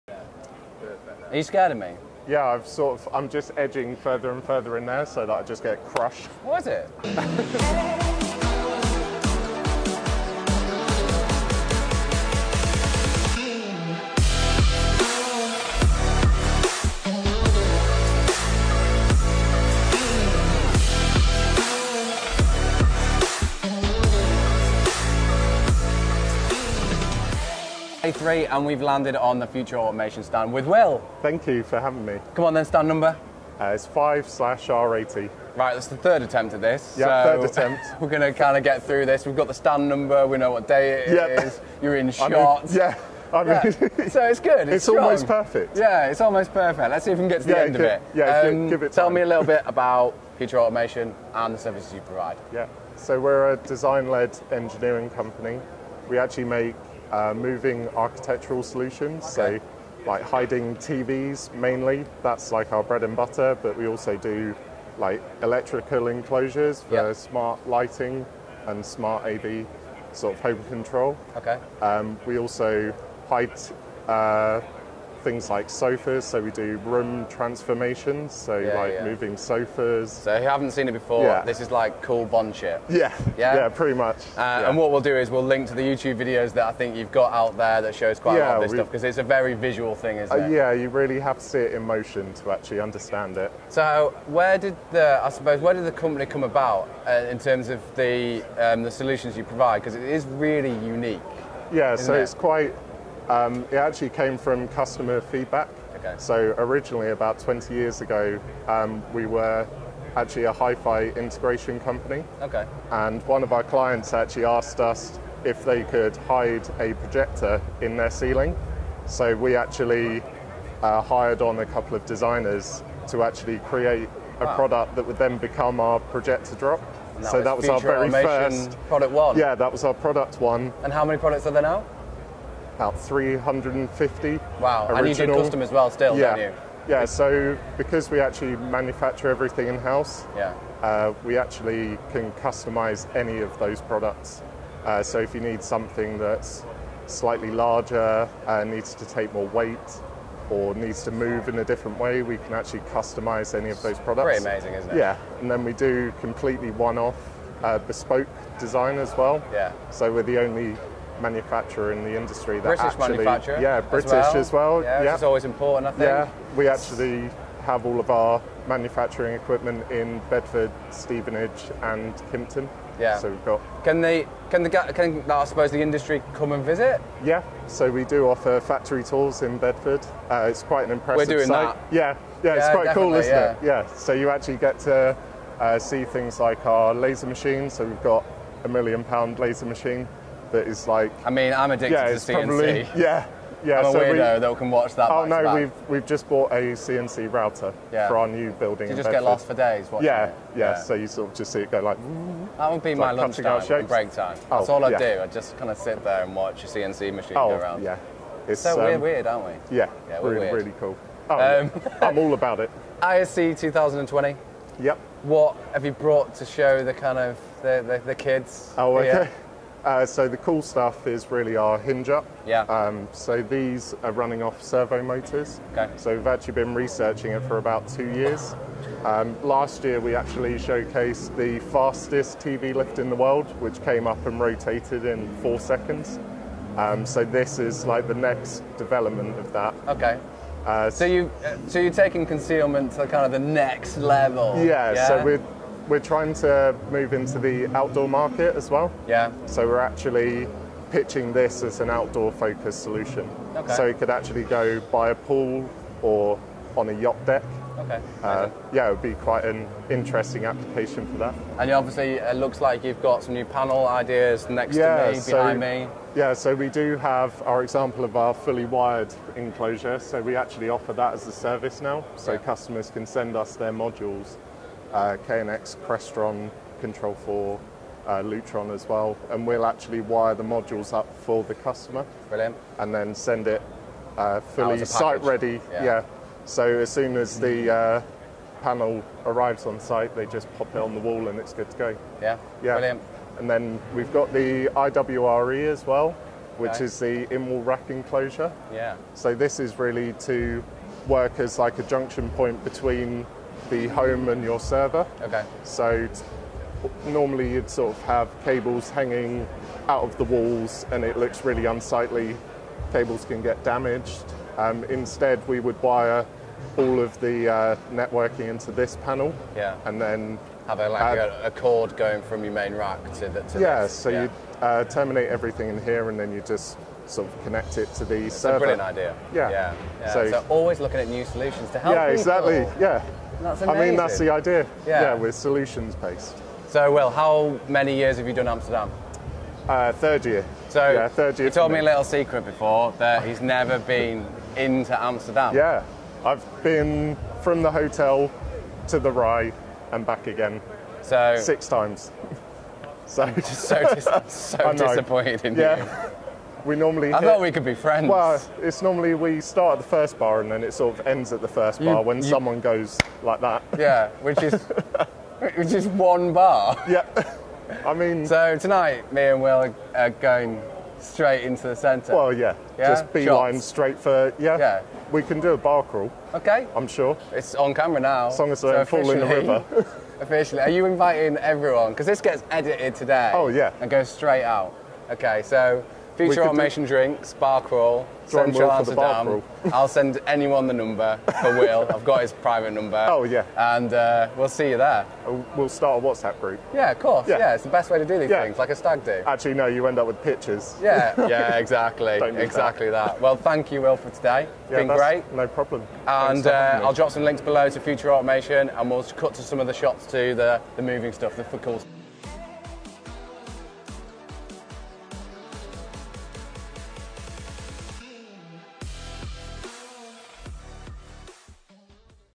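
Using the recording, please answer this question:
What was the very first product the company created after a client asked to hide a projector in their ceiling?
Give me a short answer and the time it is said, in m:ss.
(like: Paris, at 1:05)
projector drop, at 2:06.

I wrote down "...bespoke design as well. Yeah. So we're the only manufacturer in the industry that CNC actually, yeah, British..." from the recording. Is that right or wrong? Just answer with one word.
wrong.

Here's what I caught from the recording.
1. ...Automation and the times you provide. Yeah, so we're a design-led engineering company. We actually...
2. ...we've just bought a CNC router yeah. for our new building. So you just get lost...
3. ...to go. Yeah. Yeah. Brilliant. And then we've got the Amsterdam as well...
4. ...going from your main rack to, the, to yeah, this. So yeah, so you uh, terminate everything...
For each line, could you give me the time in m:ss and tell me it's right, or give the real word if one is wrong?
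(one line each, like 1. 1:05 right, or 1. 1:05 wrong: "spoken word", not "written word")
1. 0:50 wrong: "services", not "times"
2. 3:15 right
3. 4:51 wrong: "IWRE", not "Amsterdam"
4. 5:21 right.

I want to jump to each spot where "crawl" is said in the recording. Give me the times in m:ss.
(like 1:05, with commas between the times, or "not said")
6:15, 6:27.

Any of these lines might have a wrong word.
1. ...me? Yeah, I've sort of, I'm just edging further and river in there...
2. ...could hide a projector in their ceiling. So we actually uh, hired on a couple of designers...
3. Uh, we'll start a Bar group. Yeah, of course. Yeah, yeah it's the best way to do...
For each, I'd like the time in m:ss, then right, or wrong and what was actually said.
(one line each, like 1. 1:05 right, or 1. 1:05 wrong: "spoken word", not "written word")
1. 0:01 wrong: "further", not "river"
2. 1:55 right
3. 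6:35 wrong: "WhatsApp", not "Bar".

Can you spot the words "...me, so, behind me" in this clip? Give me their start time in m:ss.
4:25.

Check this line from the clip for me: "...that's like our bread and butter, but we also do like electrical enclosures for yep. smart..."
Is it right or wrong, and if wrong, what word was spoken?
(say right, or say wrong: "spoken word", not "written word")
right.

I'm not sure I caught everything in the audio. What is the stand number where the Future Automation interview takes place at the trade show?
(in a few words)
5/R80.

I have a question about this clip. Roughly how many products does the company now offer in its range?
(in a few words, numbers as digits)
350.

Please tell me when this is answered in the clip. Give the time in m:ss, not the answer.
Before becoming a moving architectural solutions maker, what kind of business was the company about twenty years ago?
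1:50.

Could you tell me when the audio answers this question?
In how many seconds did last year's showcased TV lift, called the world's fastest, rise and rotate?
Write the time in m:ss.
3:55.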